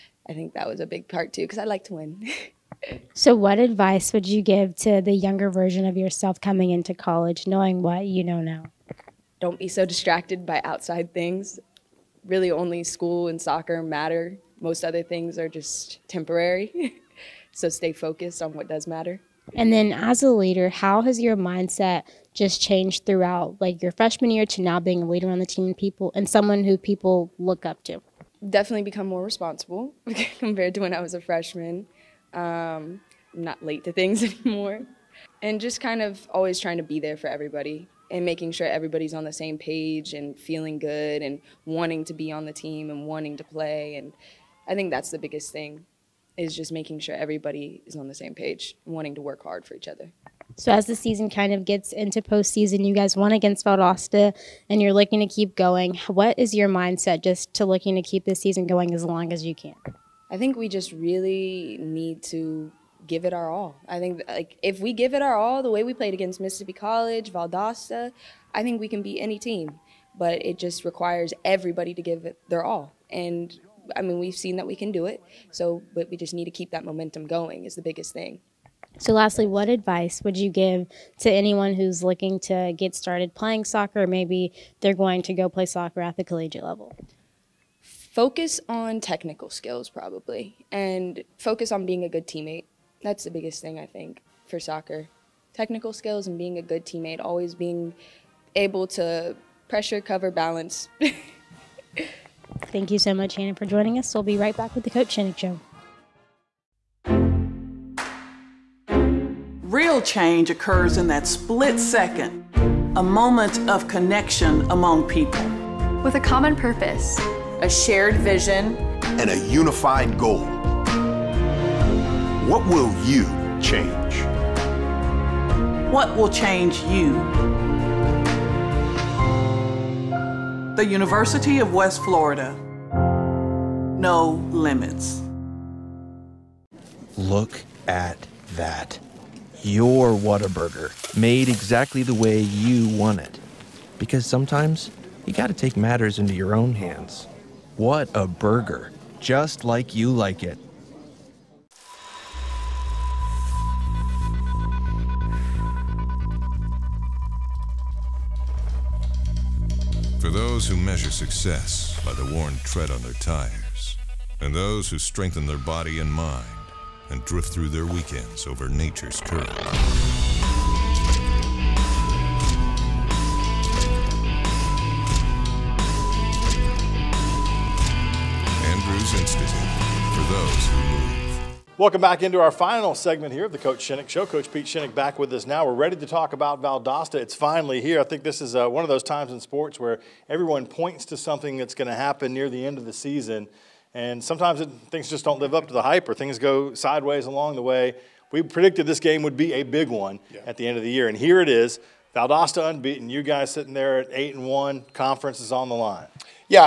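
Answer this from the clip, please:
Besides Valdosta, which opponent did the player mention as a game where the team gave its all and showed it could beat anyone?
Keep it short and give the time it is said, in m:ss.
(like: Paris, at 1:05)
Mississippi College, at 1:06.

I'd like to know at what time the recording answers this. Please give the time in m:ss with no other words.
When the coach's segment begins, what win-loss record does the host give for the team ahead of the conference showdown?
3:24.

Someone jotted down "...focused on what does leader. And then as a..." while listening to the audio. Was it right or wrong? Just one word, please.
wrong.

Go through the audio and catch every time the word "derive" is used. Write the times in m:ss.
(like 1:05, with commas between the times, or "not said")
not said.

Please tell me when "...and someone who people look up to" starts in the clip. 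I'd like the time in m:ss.
0:26.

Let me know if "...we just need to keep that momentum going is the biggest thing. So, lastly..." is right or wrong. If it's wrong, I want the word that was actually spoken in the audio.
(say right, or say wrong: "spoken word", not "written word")
right.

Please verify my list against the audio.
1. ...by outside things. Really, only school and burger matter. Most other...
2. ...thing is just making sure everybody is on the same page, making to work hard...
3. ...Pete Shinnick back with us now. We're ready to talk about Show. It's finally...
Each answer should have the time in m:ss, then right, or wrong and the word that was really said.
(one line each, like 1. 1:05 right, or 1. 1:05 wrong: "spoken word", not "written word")
1. 0:10 wrong: "soccer", not "burger"
2. 0:45 wrong: "wanting", not "making"
3. 3:04 wrong: "Valdosta", not "Show".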